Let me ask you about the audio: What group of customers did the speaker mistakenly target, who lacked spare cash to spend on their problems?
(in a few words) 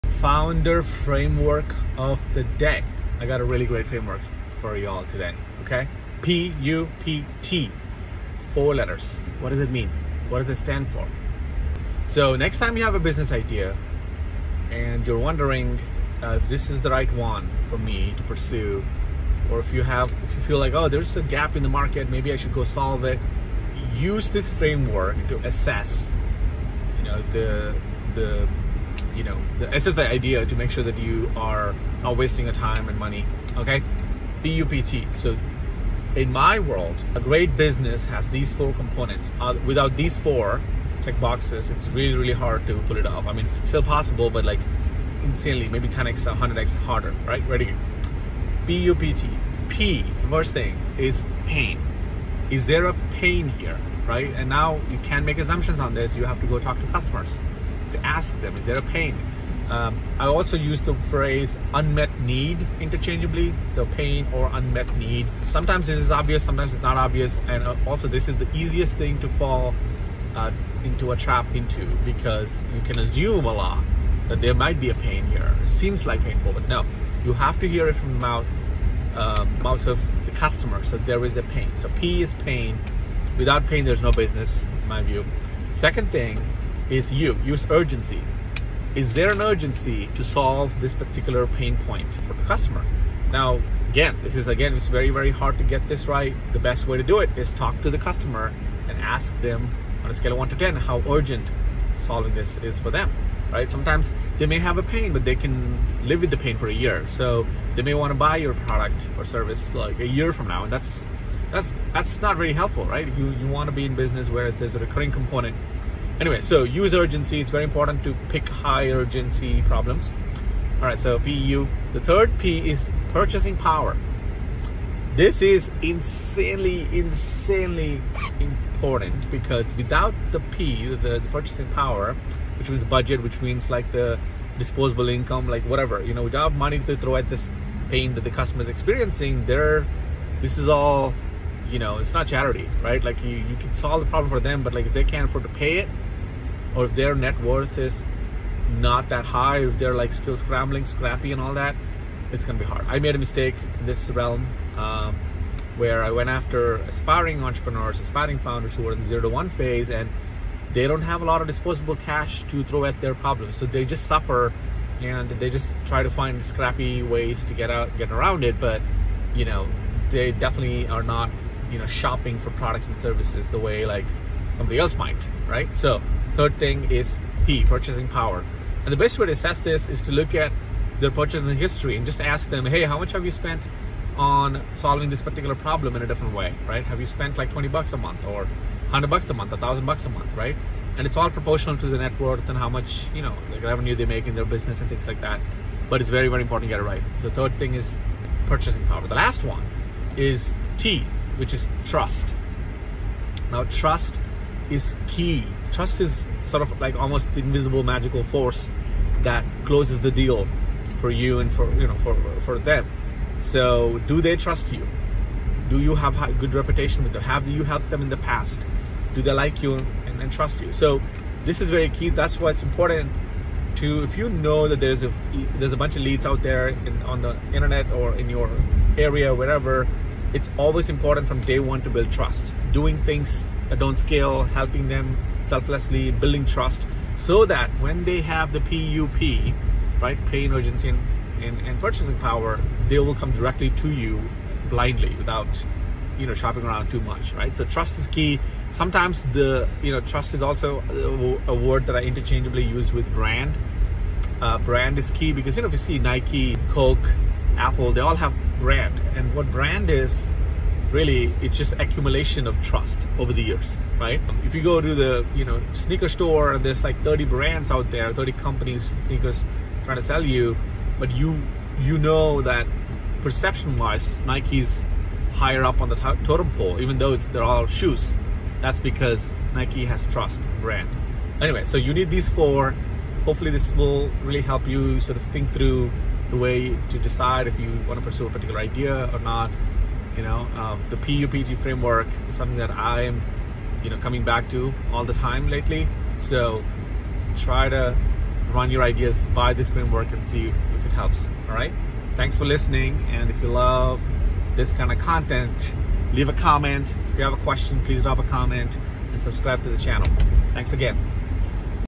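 aspiring entrepreneurs.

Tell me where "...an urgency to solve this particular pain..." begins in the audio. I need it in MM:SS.
01:29.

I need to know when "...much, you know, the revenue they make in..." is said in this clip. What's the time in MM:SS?
03:12.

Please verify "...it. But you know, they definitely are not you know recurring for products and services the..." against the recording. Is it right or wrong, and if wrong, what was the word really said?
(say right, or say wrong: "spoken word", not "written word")
wrong: "shopping", not "recurring".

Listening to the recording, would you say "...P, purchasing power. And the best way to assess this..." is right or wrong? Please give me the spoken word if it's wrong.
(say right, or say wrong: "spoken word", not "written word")
right.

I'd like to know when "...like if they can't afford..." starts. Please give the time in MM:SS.
02:24.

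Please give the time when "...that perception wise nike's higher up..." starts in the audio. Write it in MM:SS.
04:32.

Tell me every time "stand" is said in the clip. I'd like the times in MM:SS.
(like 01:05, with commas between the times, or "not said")
00:10.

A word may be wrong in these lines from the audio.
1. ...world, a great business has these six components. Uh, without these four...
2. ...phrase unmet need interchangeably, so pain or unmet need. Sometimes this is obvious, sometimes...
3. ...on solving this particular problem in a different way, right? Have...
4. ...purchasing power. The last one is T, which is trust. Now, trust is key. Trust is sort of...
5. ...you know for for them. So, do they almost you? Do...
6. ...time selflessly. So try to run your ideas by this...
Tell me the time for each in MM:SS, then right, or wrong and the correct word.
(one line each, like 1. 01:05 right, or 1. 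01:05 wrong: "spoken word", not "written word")
1. 00:36 wrong: "four", not "six"
2. 01:00 right
3. 03:04 right
4. 03:18 right
5. 03:31 wrong: "trust", not "almost"
6. 04:55 wrong: "lately", not "selflessly".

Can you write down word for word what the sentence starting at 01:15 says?
It seems like painful, but no.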